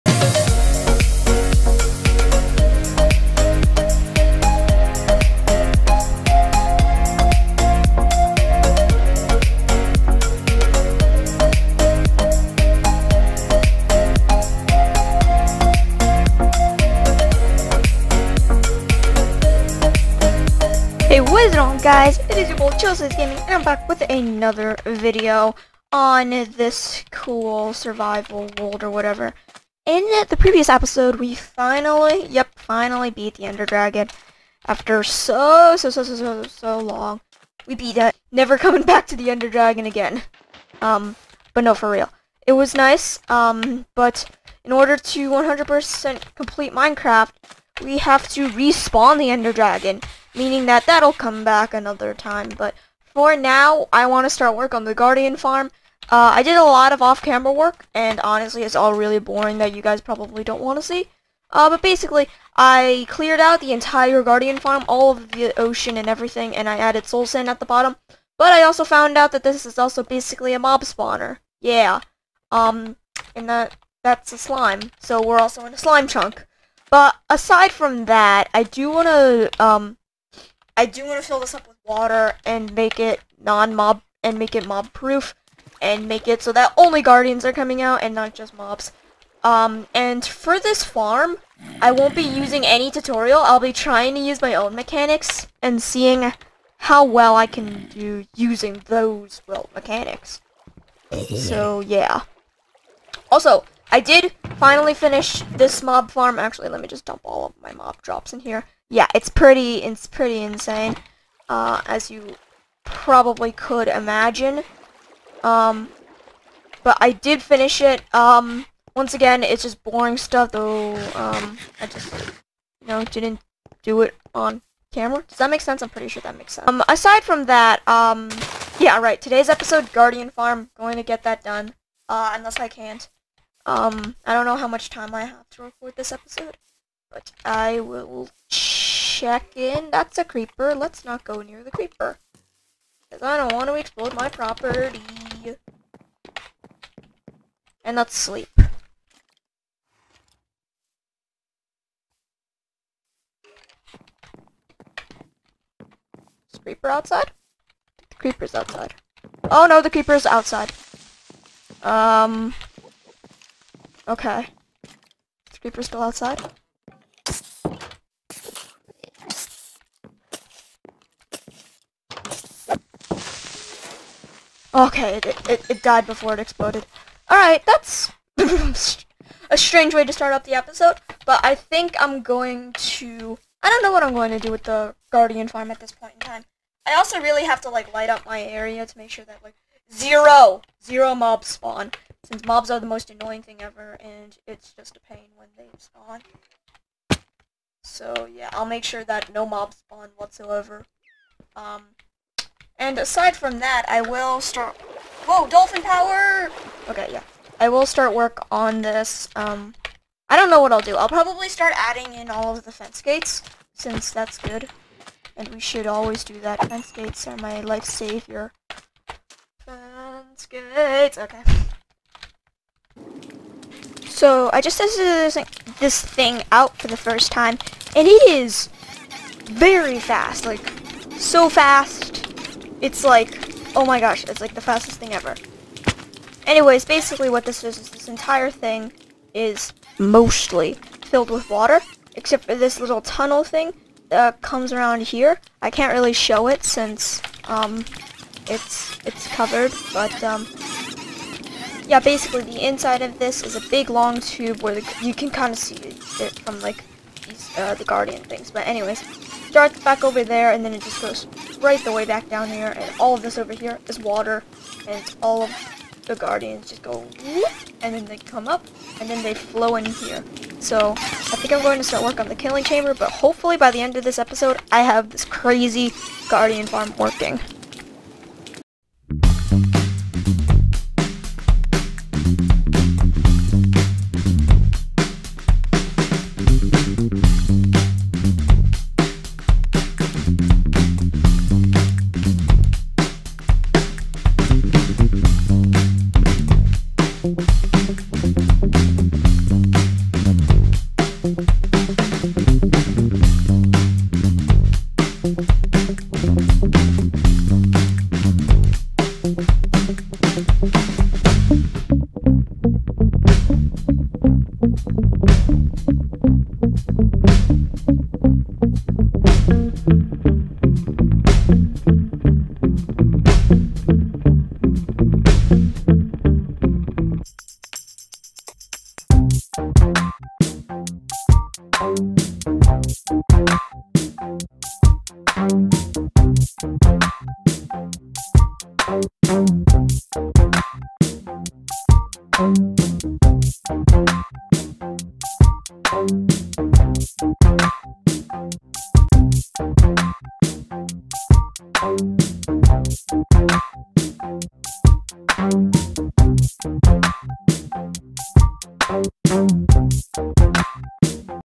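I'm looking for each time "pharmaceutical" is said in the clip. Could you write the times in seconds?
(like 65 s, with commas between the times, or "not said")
not said.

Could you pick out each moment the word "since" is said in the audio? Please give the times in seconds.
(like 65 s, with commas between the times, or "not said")
192 s, 213 s, 246 s.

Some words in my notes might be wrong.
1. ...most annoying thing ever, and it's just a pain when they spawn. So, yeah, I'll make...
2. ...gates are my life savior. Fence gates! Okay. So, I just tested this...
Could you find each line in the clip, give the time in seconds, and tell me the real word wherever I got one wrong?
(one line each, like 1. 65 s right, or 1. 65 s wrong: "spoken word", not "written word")
1. 192 s right
2. 216 s right.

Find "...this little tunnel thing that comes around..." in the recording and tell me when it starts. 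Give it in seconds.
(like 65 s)
242 s.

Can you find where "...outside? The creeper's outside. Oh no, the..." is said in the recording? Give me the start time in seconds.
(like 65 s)
156 s.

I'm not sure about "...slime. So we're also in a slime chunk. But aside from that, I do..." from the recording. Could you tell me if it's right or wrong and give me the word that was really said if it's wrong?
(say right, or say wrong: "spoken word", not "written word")
right.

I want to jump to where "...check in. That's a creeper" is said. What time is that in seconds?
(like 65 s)
139 s.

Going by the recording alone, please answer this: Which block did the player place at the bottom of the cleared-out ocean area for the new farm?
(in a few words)
soul sand.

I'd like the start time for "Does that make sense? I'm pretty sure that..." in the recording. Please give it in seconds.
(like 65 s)
125 s.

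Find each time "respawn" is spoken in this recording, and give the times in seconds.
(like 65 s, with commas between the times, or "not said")
48 s.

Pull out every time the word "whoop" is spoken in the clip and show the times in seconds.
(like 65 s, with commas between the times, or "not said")
267 s.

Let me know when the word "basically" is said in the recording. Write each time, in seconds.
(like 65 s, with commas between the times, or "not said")
61 s, 70 s, 236 s, 251 s.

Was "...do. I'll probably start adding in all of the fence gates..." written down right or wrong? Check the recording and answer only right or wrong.
right.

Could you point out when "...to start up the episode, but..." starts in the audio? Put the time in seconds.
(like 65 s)
180 s.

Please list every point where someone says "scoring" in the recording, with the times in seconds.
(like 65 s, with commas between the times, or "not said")
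not said.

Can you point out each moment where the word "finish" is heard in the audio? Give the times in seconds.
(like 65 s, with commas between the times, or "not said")
104 s, 117 s.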